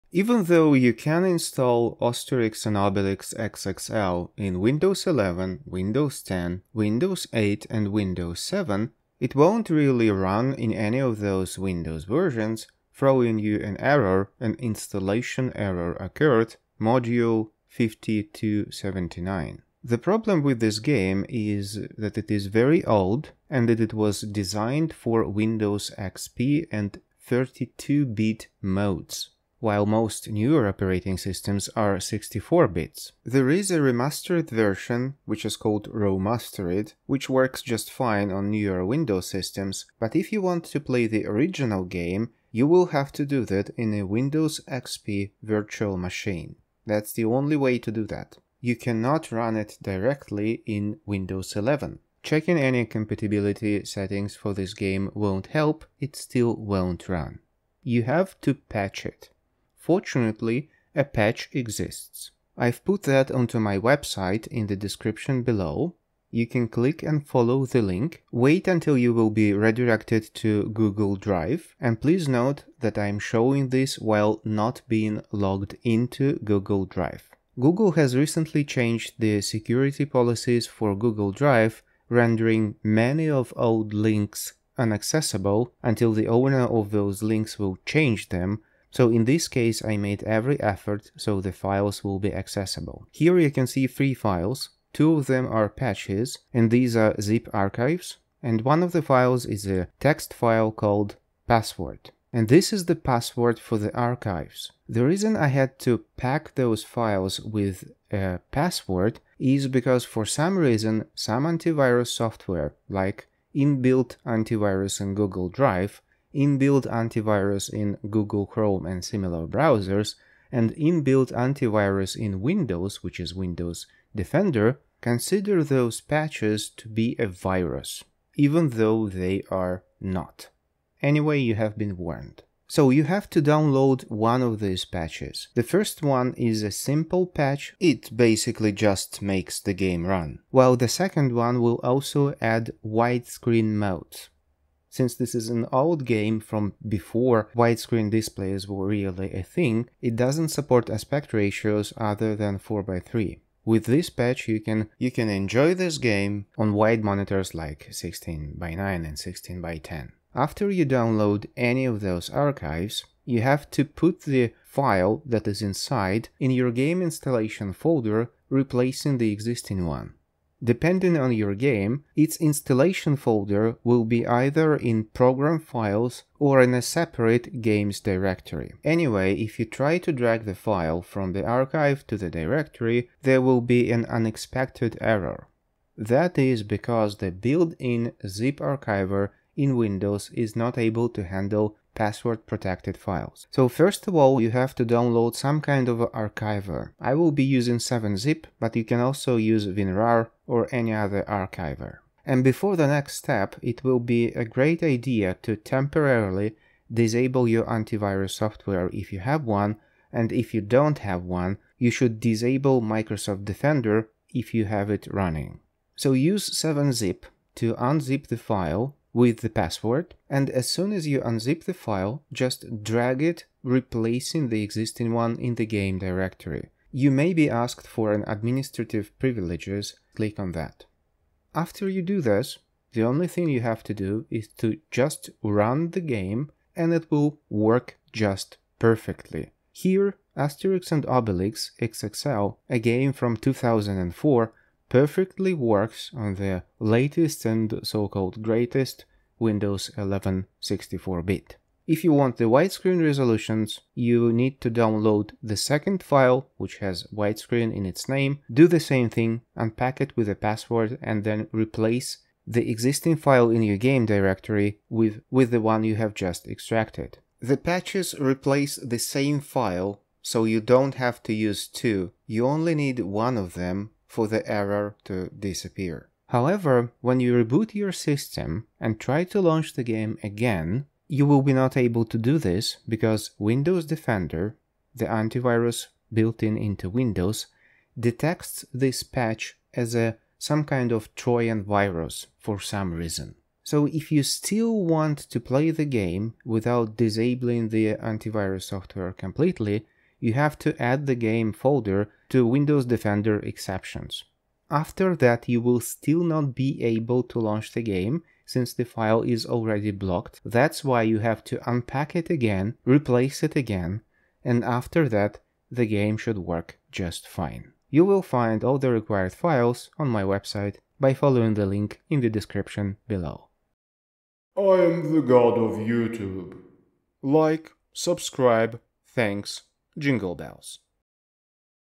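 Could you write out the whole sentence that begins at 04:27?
The patches replace the same file, so you don't have to use two.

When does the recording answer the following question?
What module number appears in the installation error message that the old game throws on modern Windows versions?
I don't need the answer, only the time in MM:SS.
00:16.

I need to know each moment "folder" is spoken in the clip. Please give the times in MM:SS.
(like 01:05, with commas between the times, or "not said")
02:47, 02:53, 05:01.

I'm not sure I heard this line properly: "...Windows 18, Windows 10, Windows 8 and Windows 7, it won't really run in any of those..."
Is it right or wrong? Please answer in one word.
wrong.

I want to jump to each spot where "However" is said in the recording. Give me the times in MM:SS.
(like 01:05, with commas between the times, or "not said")
04:36.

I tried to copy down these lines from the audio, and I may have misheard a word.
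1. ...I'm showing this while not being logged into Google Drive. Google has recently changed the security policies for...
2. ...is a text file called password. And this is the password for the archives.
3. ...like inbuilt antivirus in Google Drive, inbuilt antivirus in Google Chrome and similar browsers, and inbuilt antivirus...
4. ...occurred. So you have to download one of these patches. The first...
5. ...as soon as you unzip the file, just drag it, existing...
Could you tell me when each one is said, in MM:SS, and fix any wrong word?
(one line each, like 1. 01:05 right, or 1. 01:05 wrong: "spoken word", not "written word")
1. 01:12 right
2. 01:39 right
3. 01:52 right
4. 02:11 wrong: "warned", not "occurred"
5. 03:40 wrong: "replacing", not "existing".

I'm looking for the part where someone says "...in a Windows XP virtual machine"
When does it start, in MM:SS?
00:43.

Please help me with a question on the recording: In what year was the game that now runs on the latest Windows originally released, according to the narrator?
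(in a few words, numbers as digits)
2004.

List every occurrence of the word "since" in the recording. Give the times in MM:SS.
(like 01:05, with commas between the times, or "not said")
02:24, 05:08.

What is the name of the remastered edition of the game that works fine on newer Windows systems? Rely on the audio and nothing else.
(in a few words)
Romastered.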